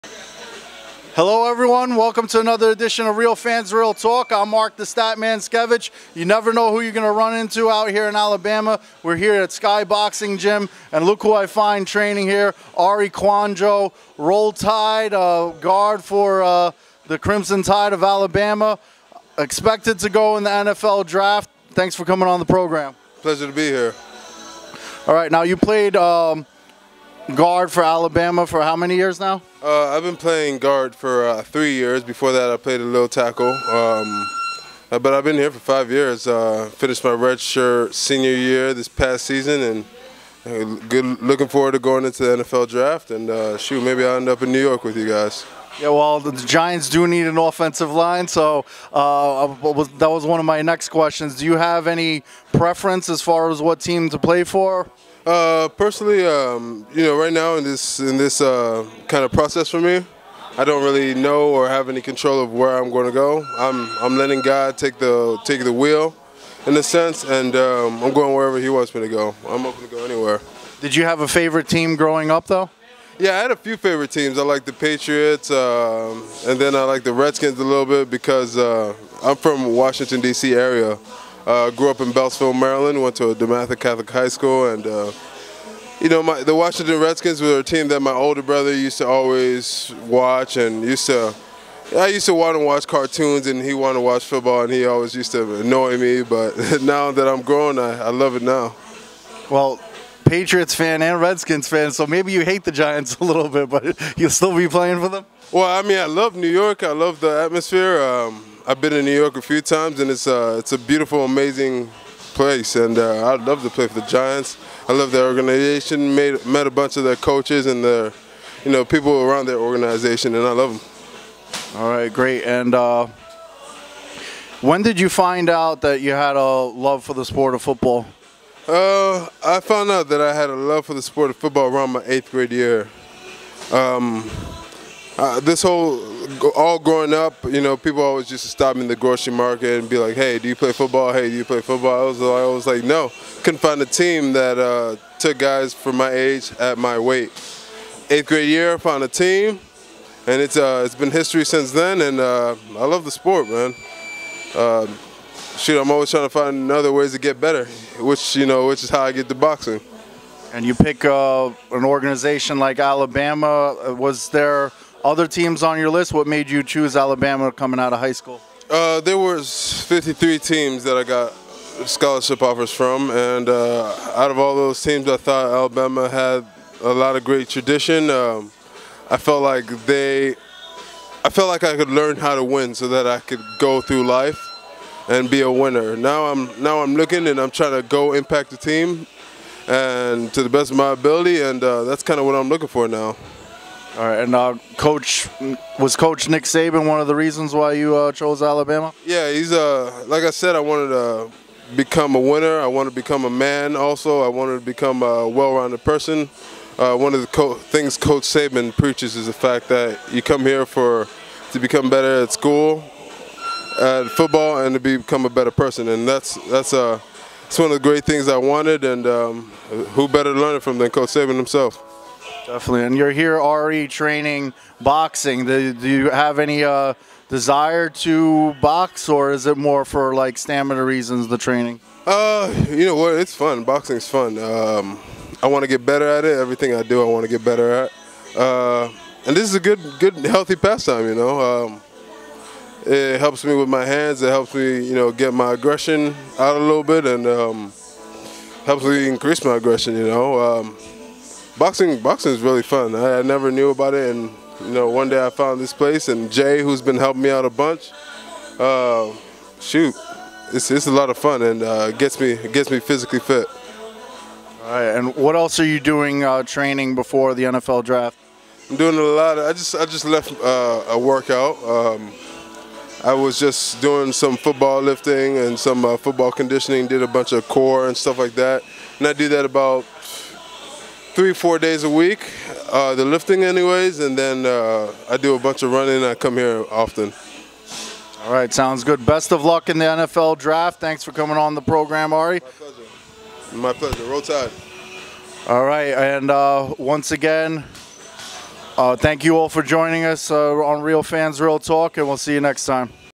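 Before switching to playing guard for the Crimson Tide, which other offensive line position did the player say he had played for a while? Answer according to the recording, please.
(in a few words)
Tackle.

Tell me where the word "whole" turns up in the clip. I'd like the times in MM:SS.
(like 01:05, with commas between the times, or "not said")
02:15.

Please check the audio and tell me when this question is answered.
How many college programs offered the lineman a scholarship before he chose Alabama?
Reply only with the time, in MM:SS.
02:49.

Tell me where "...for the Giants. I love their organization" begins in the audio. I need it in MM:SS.
01:53.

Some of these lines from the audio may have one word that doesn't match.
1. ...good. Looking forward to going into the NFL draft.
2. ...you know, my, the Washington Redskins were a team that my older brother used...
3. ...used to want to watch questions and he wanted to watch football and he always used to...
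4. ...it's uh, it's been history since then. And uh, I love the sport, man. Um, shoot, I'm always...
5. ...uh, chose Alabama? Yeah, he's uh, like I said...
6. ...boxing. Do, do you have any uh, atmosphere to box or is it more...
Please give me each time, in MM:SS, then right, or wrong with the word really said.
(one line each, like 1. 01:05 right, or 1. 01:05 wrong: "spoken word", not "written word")
1. 00:40 right
2. 01:25 right
3. 01:32 wrong: "cartoons", not "questions"
4. 02:30 right
5. 03:17 right
6. 03:44 wrong: "desire", not "atmosphere".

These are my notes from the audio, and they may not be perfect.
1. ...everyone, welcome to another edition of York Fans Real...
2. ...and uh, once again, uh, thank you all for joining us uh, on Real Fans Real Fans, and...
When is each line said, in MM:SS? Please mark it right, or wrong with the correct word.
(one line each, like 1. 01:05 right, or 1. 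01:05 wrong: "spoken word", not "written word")
1. 00:01 wrong: "Real", not "York"
2. 04:55 wrong: "Talk", not "Fans".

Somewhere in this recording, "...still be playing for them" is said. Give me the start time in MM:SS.
01:44.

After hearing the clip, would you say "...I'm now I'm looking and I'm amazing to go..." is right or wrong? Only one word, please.
wrong.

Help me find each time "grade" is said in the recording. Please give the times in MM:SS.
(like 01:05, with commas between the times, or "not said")
02:12, 02:28.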